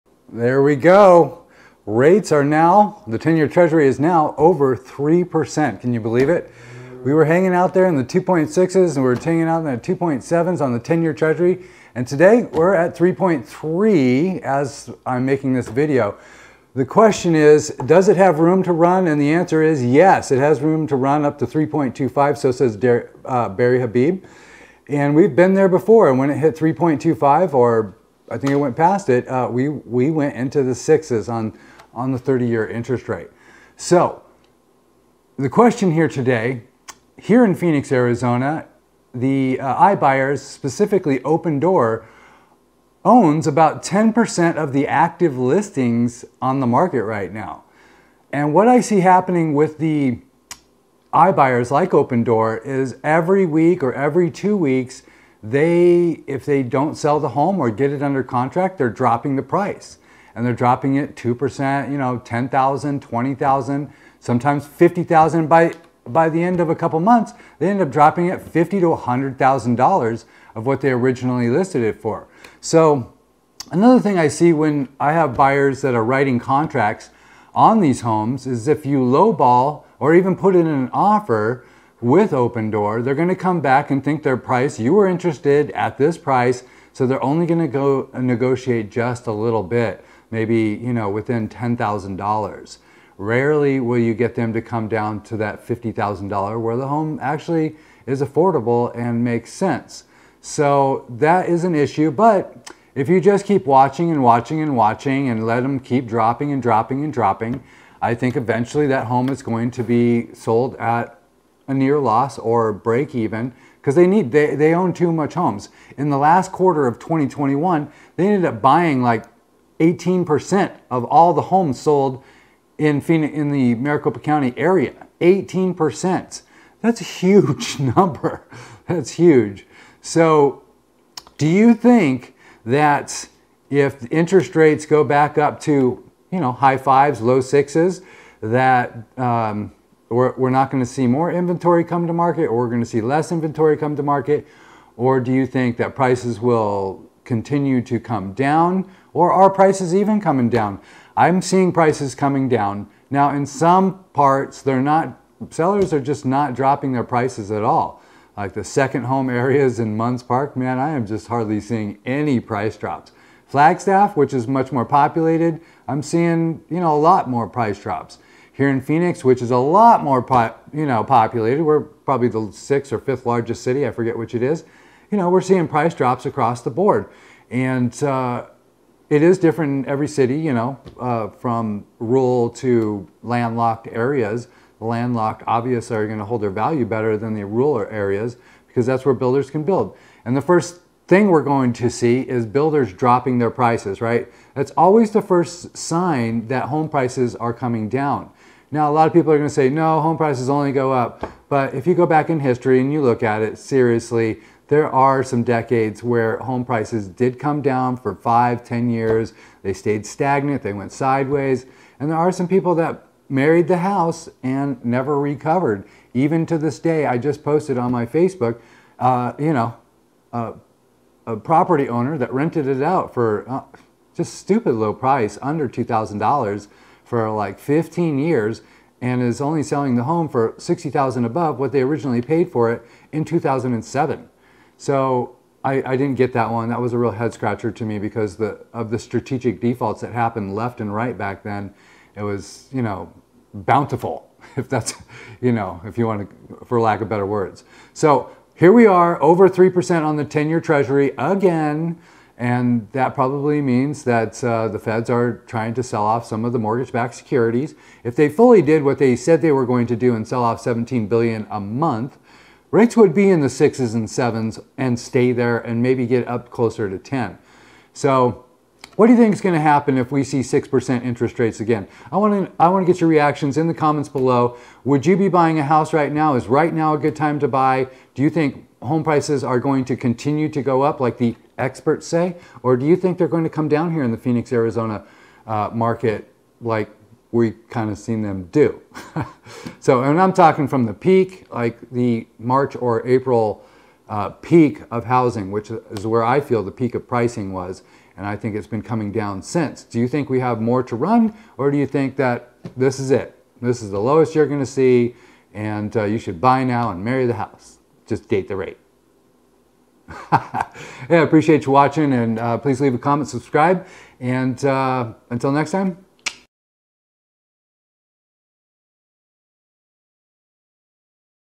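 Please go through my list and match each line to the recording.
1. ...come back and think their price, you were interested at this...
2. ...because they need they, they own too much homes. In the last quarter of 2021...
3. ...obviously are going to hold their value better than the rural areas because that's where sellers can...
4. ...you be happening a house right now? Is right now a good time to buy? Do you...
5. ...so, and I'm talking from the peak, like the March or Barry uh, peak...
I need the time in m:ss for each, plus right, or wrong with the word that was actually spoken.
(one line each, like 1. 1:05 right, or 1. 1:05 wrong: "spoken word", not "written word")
1. 1:23 right
2. 1:53 right
3. 3:05 wrong: "builders", not "sellers"
4. 4:35 wrong: "buying", not "happening"
5. 4:49 wrong: "April", not "Barry".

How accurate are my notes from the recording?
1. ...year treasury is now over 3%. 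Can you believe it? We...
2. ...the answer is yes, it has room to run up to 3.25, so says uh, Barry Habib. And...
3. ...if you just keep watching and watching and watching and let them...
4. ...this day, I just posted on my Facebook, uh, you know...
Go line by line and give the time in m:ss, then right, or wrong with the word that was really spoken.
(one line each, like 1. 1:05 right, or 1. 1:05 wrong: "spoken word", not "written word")
1. 0:03 right
2. 0:19 right
3. 1:42 right
4. 3:36 right.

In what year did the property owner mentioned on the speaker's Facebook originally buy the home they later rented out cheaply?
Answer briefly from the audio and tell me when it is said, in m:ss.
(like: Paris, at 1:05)
2007, at 3:53.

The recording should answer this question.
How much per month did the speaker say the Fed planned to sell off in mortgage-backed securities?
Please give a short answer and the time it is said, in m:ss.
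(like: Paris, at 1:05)
17 billion, at 4:20.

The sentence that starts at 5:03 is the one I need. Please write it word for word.
This is the lowest you're going to see, and uh, you should buy now and marry the house just date the rate.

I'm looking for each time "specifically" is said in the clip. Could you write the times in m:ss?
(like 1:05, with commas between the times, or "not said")
0:40.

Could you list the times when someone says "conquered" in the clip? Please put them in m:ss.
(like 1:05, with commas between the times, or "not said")
not said.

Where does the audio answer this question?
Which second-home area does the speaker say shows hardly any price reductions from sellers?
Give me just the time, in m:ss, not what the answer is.
2:39.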